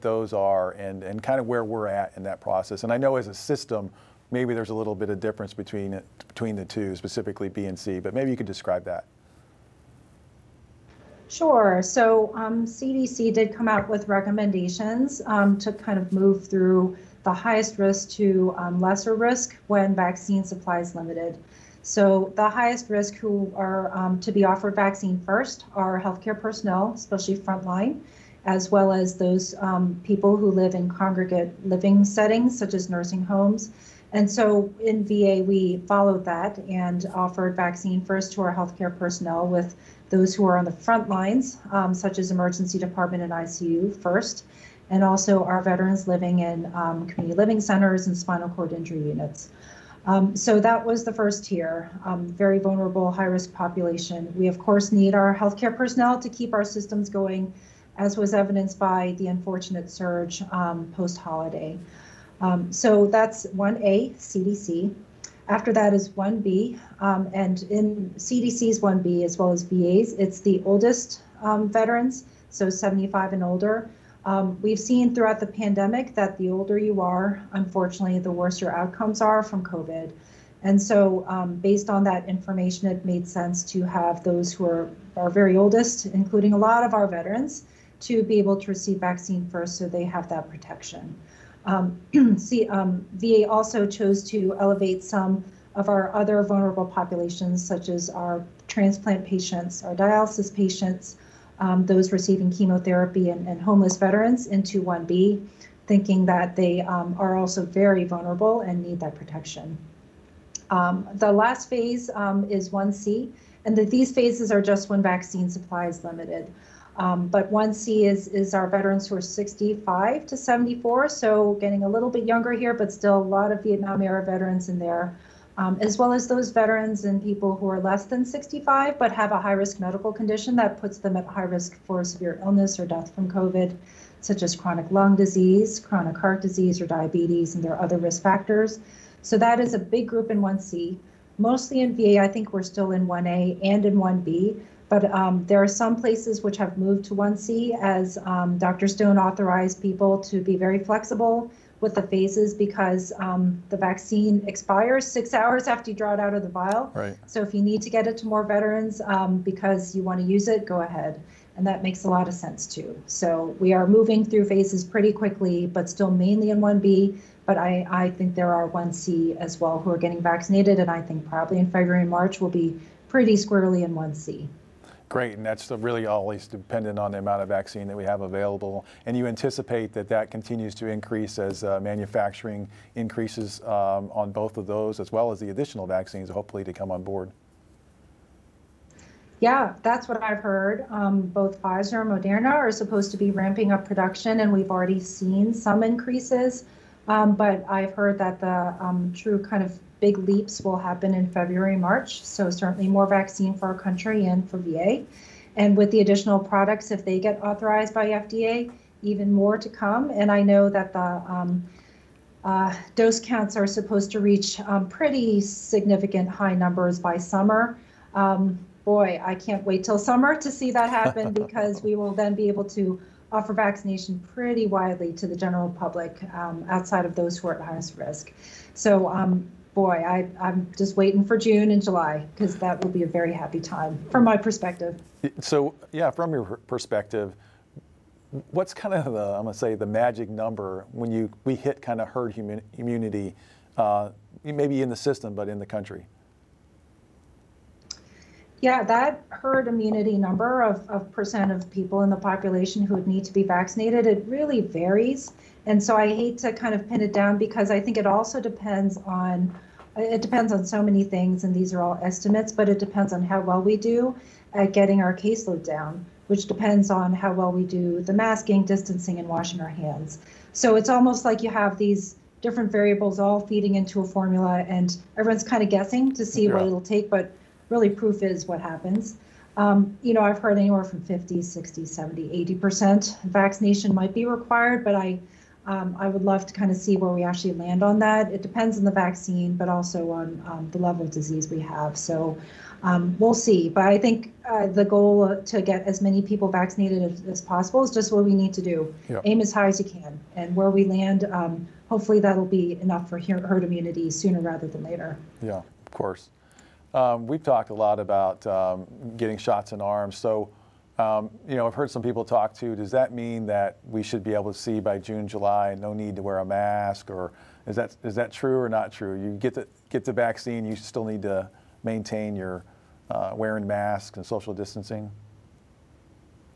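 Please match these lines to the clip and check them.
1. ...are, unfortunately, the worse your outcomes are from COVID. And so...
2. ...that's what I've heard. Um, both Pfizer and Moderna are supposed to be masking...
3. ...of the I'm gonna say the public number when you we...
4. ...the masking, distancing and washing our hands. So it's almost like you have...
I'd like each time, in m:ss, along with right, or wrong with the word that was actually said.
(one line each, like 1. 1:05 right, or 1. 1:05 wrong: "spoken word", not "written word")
1. 1:17 right
2. 3:09 wrong: "ramping", not "masking"
3. 3:58 wrong: "magic", not "public"
4. 4:28 right.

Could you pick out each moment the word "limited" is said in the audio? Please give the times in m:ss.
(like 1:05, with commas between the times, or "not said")
0:20, 1:56.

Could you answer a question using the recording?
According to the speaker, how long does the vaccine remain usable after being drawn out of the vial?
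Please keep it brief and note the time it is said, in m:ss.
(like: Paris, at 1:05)
6 hours, at 2:35.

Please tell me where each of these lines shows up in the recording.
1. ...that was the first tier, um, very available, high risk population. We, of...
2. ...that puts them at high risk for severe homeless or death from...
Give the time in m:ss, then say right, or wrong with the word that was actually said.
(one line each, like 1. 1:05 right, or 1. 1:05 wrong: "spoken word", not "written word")
1. 0:50 wrong: "vulnerable", not "available"
2. 2:10 wrong: "illness", not "homeless".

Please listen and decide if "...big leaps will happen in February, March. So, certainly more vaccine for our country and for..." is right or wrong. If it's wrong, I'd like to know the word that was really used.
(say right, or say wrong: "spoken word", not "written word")
right.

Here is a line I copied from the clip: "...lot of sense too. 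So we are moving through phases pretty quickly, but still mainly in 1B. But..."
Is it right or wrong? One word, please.
right.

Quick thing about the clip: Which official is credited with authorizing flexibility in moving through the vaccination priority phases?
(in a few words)
Dr. Stone.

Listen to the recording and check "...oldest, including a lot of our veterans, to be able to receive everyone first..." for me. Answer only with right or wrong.
wrong.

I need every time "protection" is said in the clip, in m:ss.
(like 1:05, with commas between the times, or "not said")
1:30, 1:49.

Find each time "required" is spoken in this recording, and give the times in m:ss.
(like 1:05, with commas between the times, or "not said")
4:44.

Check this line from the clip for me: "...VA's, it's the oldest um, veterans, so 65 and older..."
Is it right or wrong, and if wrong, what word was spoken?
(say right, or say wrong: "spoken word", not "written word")
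wrong: "75", not "65".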